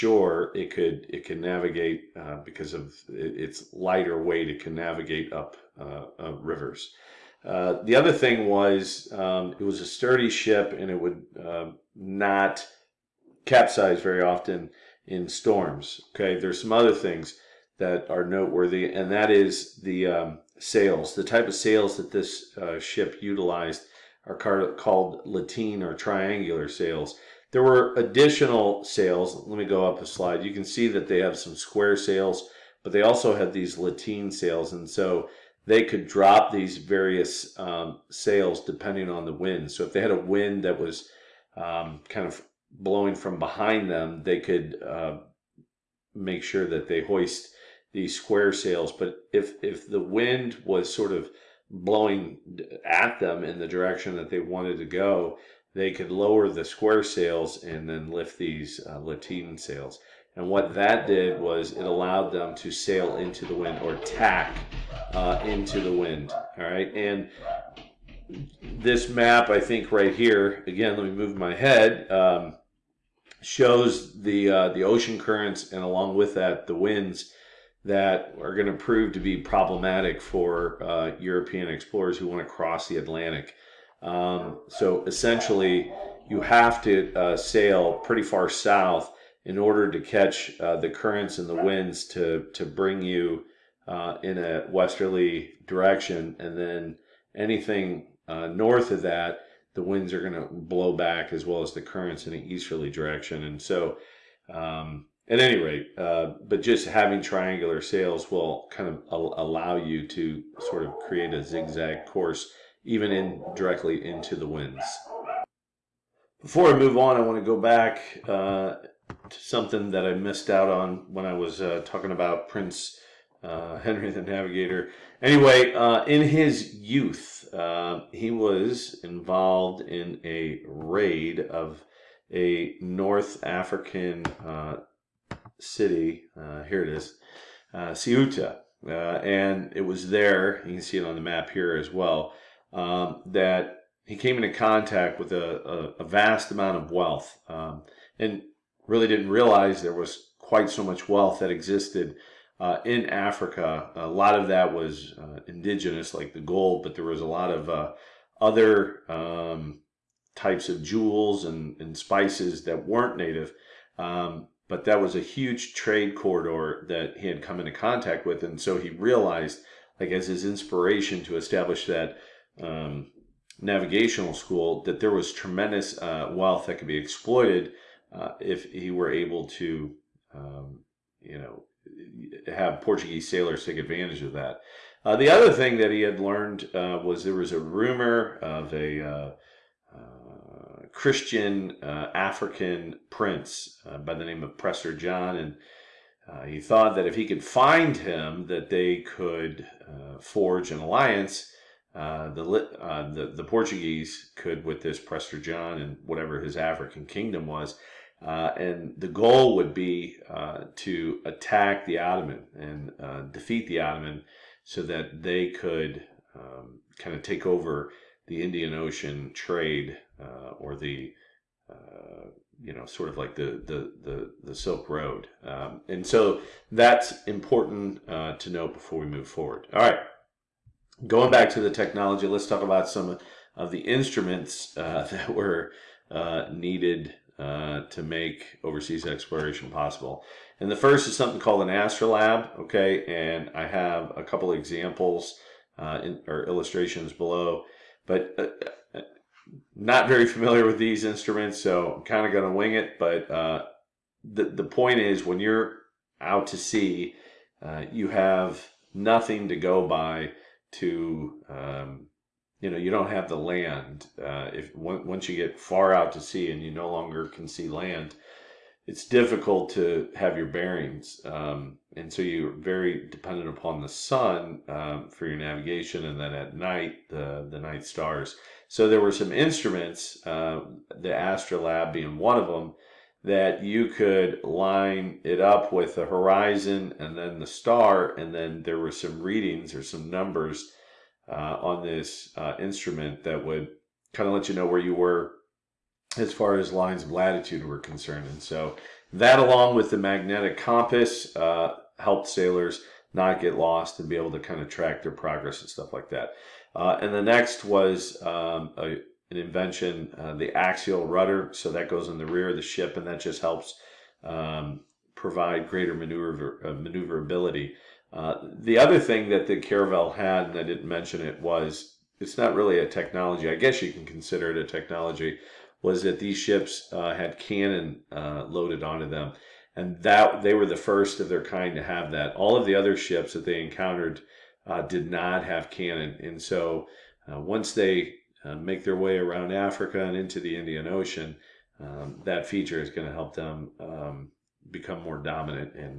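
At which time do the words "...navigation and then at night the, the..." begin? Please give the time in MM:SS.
04:35.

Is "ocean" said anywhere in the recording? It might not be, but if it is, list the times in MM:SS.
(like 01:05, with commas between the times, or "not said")
01:14, 03:38, 05:40.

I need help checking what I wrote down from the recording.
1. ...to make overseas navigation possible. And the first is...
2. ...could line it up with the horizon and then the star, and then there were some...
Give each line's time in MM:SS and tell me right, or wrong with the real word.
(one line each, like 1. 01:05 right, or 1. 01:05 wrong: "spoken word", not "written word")
1. 03:57 wrong: "exploration", not "navigation"
2. 04:43 right.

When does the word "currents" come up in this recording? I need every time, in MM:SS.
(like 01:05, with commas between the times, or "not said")
01:15, 01:30, 01:41.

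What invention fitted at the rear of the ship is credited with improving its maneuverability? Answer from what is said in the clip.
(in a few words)
axial rudder.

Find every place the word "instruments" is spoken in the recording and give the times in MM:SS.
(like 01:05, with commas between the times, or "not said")
03:53, 04:11, 04:39, 04:52.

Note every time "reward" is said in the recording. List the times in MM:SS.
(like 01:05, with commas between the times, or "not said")
not said.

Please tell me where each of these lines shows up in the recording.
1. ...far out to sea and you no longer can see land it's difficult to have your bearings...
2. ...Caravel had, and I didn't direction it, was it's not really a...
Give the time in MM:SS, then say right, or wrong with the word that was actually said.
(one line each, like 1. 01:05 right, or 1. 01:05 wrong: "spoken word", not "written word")
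1. 04:25 right
2. 05:19 wrong: "mention", not "direction".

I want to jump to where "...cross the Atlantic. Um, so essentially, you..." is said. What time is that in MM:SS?
01:22.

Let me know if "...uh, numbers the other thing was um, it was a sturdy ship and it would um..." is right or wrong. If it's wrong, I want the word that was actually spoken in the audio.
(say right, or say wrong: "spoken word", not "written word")
wrong: "rivers", not "numbers".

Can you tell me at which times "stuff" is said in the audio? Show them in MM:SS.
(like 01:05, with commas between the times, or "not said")
05:05.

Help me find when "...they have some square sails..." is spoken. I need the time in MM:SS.
00:31.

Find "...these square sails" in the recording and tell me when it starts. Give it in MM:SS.
00:47.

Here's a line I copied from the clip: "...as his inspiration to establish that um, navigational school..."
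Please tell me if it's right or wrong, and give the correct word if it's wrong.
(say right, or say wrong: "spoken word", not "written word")
right.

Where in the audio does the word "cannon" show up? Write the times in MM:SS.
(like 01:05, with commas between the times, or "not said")
05:27, 05:35.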